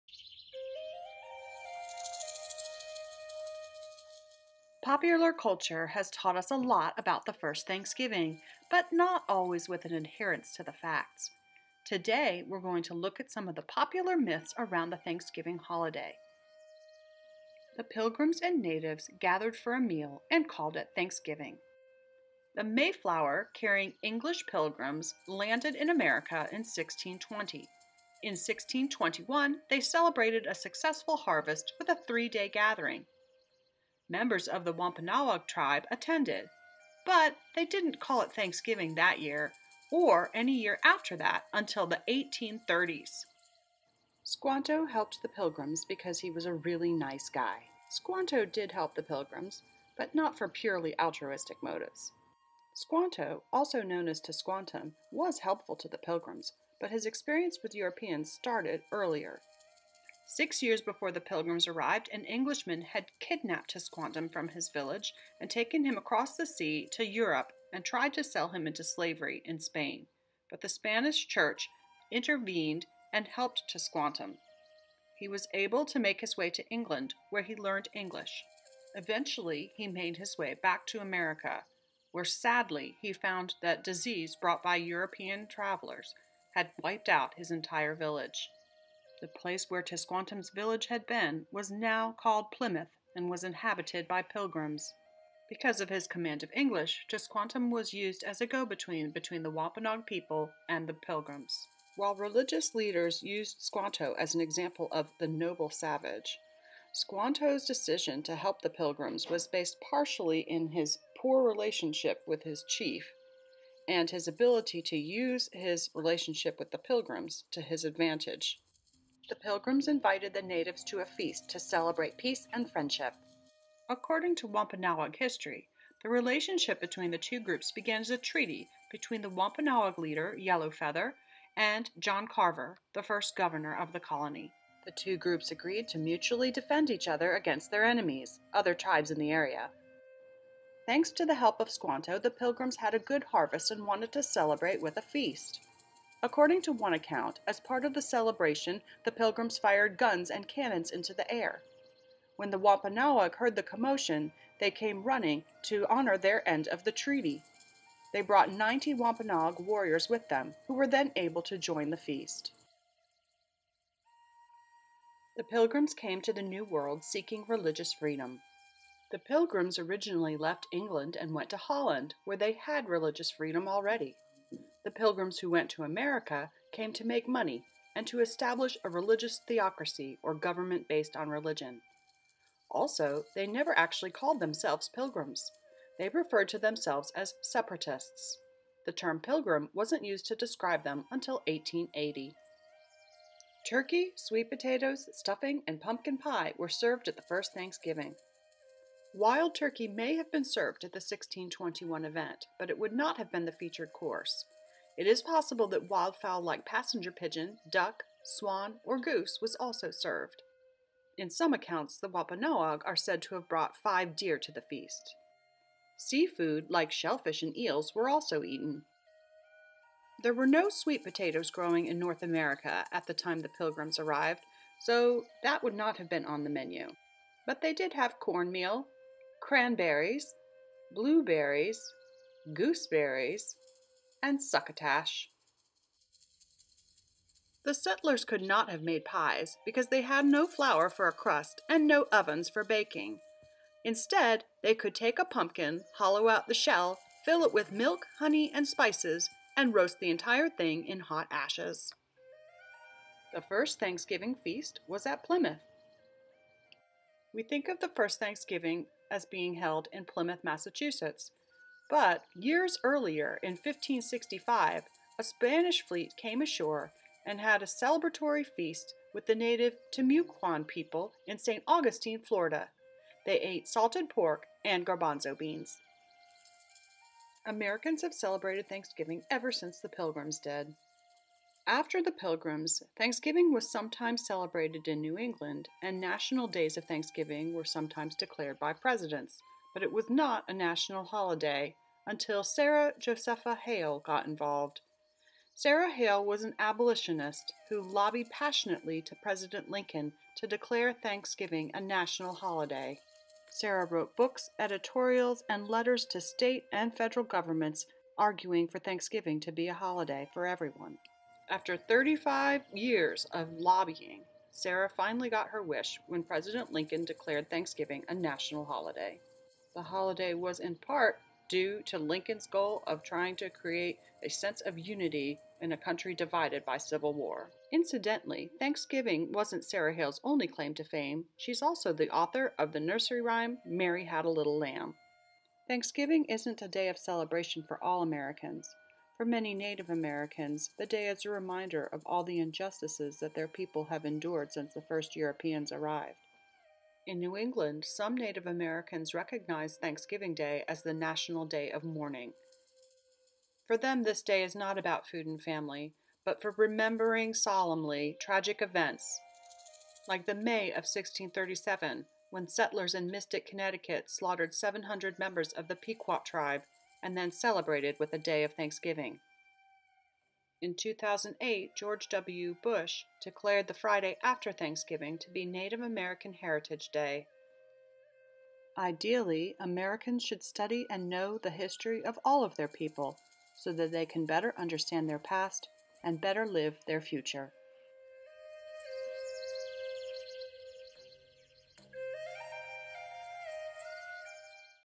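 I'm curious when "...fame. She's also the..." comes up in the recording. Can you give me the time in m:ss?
5:30.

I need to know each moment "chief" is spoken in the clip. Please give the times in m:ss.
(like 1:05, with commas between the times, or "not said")
1:52.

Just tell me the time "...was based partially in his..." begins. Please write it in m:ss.
1:49.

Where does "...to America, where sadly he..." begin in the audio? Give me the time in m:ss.
1:20.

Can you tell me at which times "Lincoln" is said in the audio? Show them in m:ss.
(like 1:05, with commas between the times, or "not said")
4:59, 5:16, 5:21.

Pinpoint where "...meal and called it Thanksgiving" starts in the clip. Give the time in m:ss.
0:19.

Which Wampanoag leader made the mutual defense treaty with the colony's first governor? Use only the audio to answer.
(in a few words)
Yellow Feather.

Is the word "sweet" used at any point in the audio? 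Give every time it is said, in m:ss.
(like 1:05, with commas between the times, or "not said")
3:14, 3:40.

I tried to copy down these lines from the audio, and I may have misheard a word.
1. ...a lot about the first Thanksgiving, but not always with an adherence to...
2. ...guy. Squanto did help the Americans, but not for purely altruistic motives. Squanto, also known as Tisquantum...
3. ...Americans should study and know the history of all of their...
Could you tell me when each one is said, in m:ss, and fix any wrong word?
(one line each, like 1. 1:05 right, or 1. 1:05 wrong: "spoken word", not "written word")
1. 0:06 right
2. 0:47 wrong: "Pilgrims", not "Americans"
3. 6:19 right.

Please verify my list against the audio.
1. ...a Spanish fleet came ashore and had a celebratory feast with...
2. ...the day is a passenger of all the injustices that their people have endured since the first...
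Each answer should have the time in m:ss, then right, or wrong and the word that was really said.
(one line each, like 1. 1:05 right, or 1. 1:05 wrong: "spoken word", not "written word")
1. 4:25 right
2. 5:40 wrong: "reminder", not "passenger".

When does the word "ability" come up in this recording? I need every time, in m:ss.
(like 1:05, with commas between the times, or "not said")
1:54.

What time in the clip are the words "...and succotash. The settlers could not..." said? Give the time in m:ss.
3:54.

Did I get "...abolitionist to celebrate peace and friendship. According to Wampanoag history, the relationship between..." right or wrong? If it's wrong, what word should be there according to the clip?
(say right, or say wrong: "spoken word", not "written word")
wrong: "feast", not "abolitionist".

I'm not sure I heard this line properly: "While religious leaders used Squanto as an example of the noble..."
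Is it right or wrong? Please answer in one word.
right.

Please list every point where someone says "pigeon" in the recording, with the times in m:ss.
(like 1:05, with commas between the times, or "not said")
3:27.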